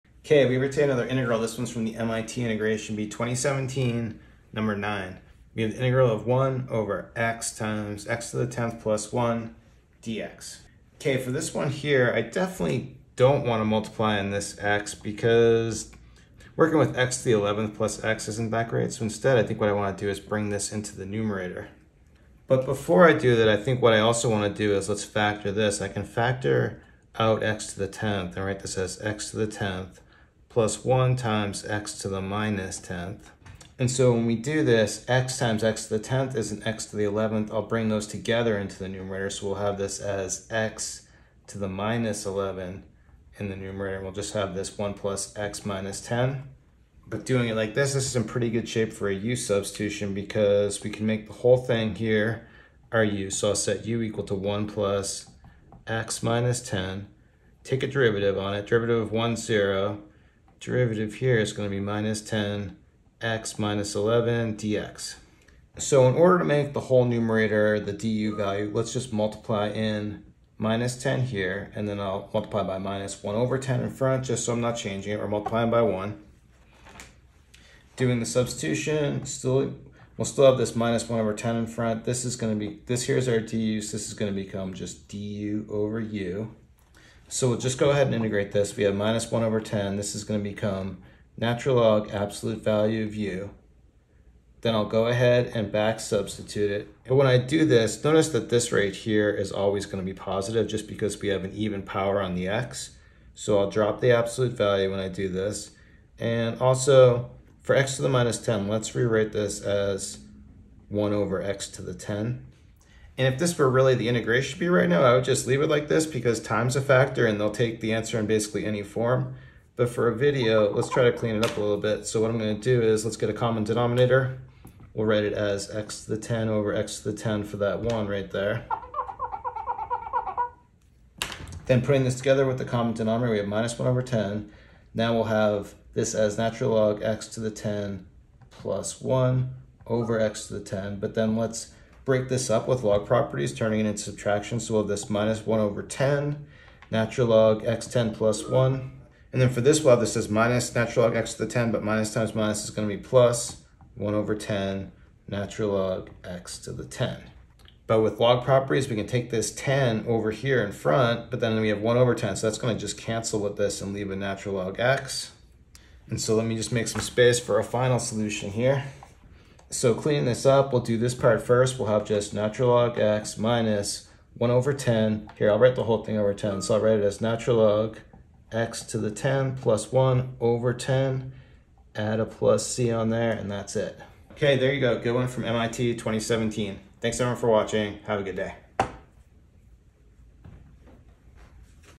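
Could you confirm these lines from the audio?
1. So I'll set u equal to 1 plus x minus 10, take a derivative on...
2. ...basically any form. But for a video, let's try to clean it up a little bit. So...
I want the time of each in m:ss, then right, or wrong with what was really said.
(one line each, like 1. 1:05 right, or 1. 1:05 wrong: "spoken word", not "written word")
1. 0:53 right
2. 1:58 right.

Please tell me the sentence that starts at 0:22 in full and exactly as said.
But before I do that, I think what I also want to do is let's factor this.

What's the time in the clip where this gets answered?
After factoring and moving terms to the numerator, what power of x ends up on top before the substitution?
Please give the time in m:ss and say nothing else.
0:40.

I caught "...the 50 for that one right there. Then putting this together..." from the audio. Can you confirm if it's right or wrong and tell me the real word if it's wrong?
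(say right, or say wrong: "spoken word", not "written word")
wrong: "10", not "50".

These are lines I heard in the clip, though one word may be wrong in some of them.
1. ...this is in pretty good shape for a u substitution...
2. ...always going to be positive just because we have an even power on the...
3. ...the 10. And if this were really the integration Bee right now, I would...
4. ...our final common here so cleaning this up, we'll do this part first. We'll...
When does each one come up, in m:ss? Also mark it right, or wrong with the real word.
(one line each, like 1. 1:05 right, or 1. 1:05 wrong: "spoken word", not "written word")
1. 0:47 right
2. 1:39 right
3. 1:51 right
4. 2:47 wrong: "solution", not "common".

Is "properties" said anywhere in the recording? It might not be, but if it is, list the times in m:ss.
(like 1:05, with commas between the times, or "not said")
2:23, 2:38.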